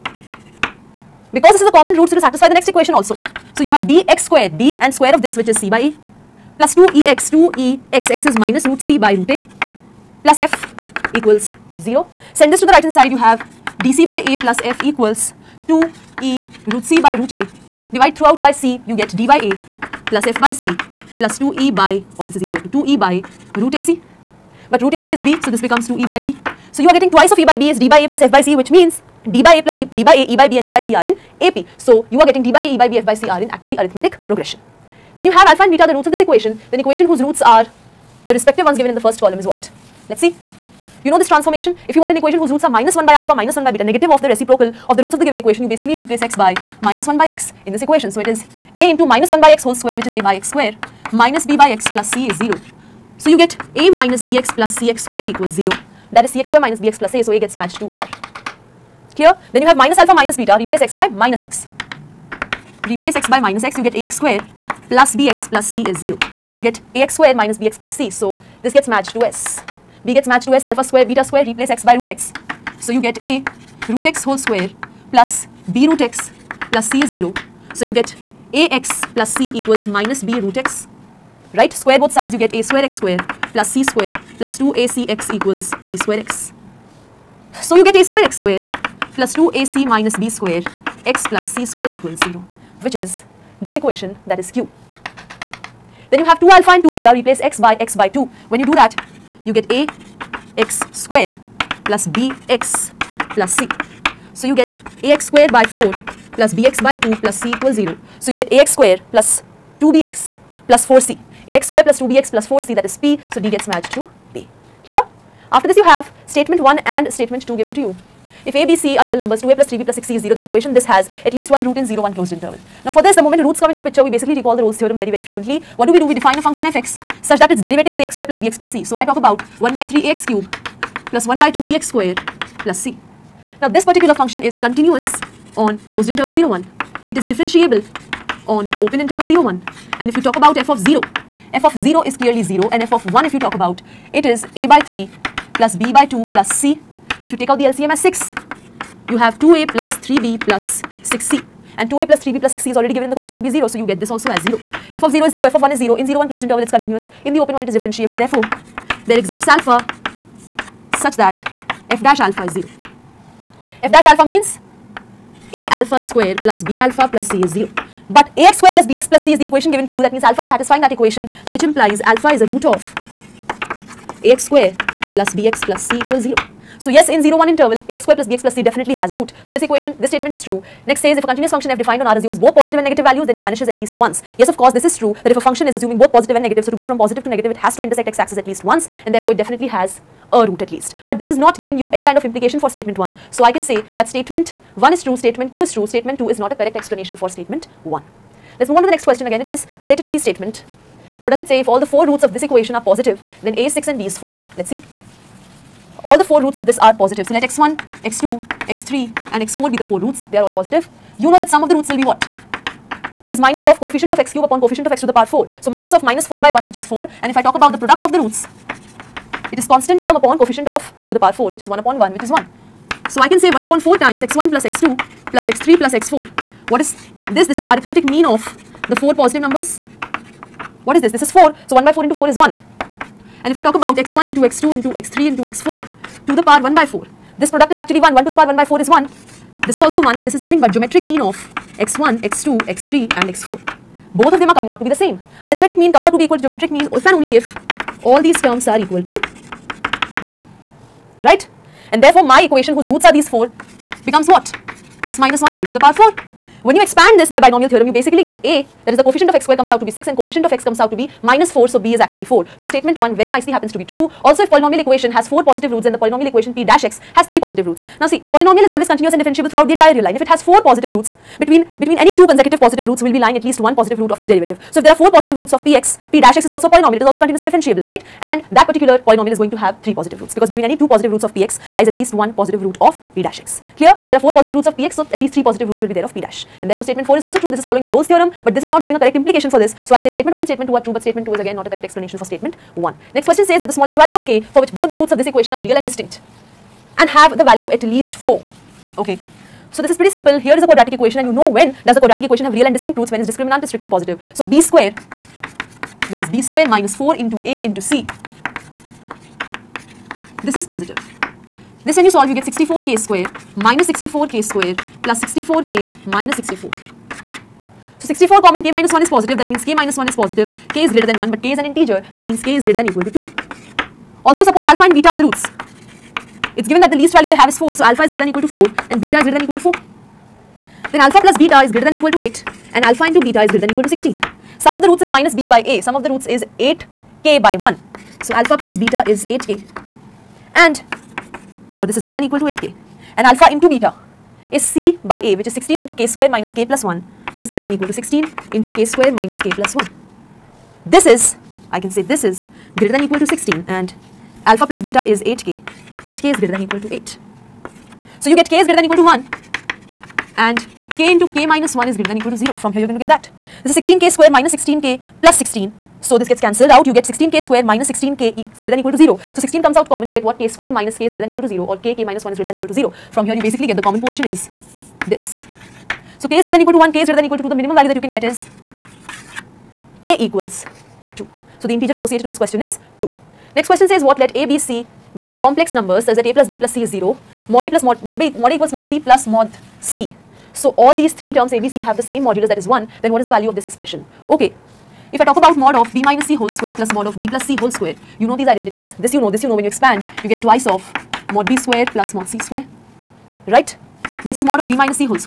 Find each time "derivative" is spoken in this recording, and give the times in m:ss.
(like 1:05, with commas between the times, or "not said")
2:07, 4:34.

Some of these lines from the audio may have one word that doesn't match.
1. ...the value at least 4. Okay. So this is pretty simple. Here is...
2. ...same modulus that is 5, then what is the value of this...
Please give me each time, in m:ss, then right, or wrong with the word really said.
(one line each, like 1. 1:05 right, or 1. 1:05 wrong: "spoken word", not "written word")
1. 4:57 right
2. 6:32 wrong: "1", not "5".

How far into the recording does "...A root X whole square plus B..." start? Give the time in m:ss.
1:13.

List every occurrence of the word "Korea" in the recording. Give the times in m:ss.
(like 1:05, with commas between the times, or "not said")
not said.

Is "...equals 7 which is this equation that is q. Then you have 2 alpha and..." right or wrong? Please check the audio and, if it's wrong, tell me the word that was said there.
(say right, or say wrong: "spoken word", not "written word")
wrong: "0", not "7".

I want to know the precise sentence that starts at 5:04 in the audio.
So b square, this is b square minus 4 into a into c.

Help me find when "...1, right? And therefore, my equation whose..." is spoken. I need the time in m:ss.
4:10.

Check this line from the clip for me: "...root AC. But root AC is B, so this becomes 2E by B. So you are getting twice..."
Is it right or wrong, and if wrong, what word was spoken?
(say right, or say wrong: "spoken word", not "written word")
right.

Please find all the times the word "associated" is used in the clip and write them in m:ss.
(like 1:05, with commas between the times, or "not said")
6:21.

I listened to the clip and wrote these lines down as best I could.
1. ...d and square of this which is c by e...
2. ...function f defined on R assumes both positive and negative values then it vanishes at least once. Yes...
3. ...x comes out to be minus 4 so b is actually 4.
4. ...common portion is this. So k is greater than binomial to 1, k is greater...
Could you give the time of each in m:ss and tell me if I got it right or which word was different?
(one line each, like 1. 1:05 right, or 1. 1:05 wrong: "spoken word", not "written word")
1. 0:04 right
2. 3:01 right
3. 4:20 right
4. 6:13 wrong: "equal", not "binomial".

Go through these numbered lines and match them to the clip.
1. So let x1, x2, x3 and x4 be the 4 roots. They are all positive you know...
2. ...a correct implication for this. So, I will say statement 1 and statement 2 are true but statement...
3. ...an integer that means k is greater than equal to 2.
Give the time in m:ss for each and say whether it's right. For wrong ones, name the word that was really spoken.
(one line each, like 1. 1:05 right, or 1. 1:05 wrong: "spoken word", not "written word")
1. 3:27 right
2. 4:48 right
3. 5:21 right.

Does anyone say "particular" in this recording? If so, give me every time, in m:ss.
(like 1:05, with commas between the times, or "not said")
2:13, 4:38.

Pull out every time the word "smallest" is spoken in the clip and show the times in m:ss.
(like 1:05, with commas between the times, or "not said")
4:53.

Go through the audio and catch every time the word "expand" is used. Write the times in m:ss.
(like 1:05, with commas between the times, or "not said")
4:16, 6:39.